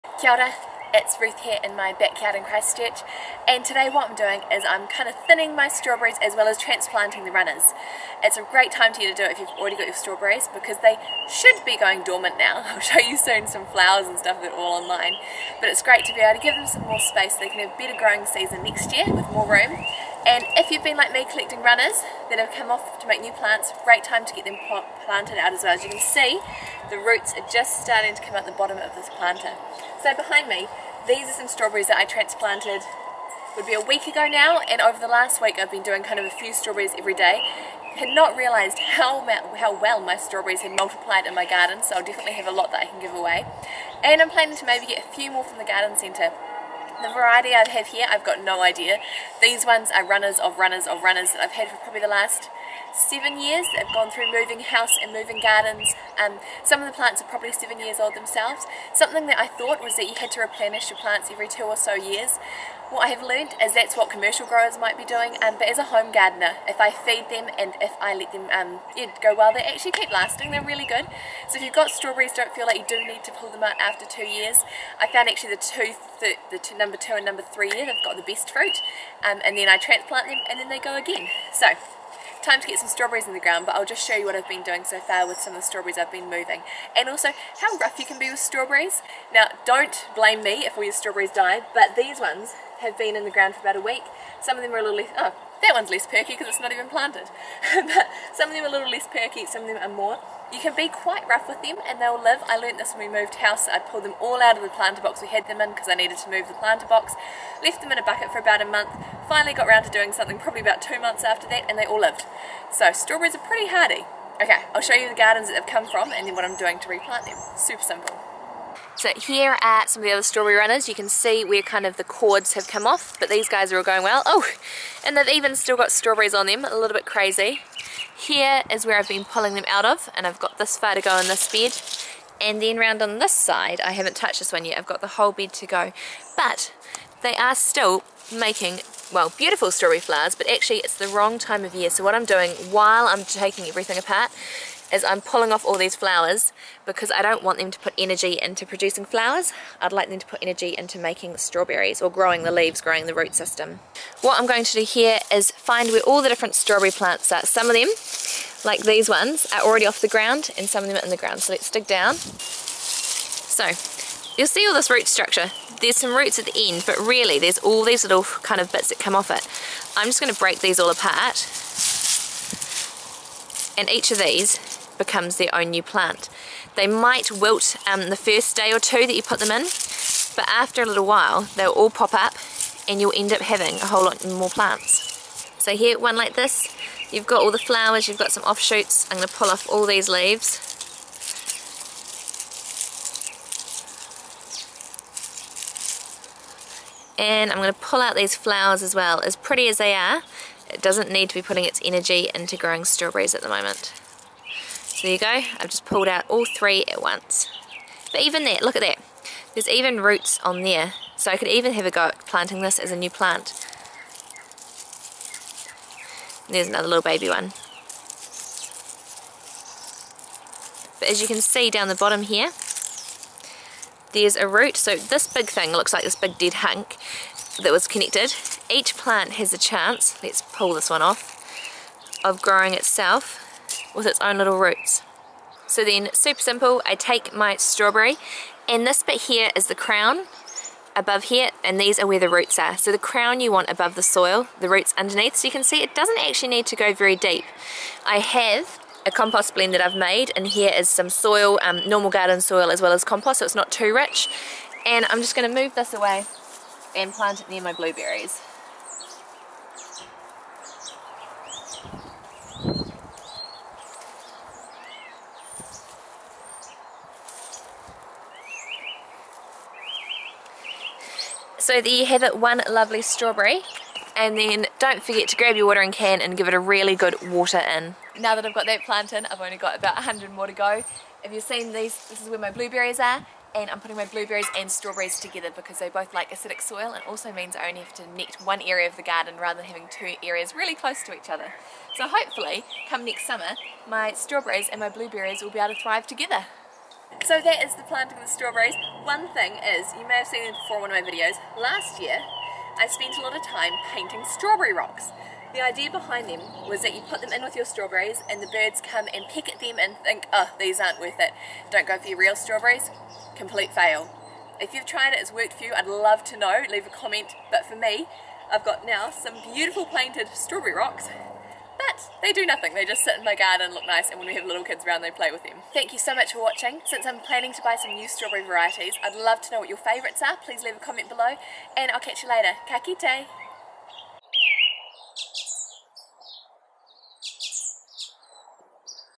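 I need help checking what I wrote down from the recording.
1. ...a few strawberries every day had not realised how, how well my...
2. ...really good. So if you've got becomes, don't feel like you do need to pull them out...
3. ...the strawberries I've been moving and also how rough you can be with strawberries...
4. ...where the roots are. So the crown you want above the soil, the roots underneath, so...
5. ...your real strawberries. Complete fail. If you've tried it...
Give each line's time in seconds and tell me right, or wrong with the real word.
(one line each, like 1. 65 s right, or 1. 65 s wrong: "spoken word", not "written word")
1. 36 s right
2. 70 s wrong: "strawberries", not "becomes"
3. 85 s right
4. 242 s right
5. 312 s right.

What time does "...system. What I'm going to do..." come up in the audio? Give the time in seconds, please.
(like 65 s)
153 s.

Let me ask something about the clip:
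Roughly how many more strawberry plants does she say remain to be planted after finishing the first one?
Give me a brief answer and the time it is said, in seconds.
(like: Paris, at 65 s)
About 100, at 279 s.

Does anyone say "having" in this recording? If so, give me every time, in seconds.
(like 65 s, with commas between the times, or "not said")
183 s, 289 s.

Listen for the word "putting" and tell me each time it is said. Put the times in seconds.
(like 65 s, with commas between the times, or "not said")
201 s, 283 s.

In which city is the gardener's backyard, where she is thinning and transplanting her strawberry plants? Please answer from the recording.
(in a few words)
Christchurch.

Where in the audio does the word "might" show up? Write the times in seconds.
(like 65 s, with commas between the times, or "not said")
64 s, 176 s.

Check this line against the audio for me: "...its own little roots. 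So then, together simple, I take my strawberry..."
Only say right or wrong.
wrong.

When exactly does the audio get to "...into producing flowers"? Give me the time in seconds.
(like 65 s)
148 s.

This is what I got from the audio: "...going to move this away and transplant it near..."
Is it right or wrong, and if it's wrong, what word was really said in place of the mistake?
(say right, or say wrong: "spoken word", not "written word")
wrong: "plant", not "transplant".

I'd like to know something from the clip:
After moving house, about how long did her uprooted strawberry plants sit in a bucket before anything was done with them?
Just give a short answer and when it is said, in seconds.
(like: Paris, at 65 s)
About a month, at 108 s.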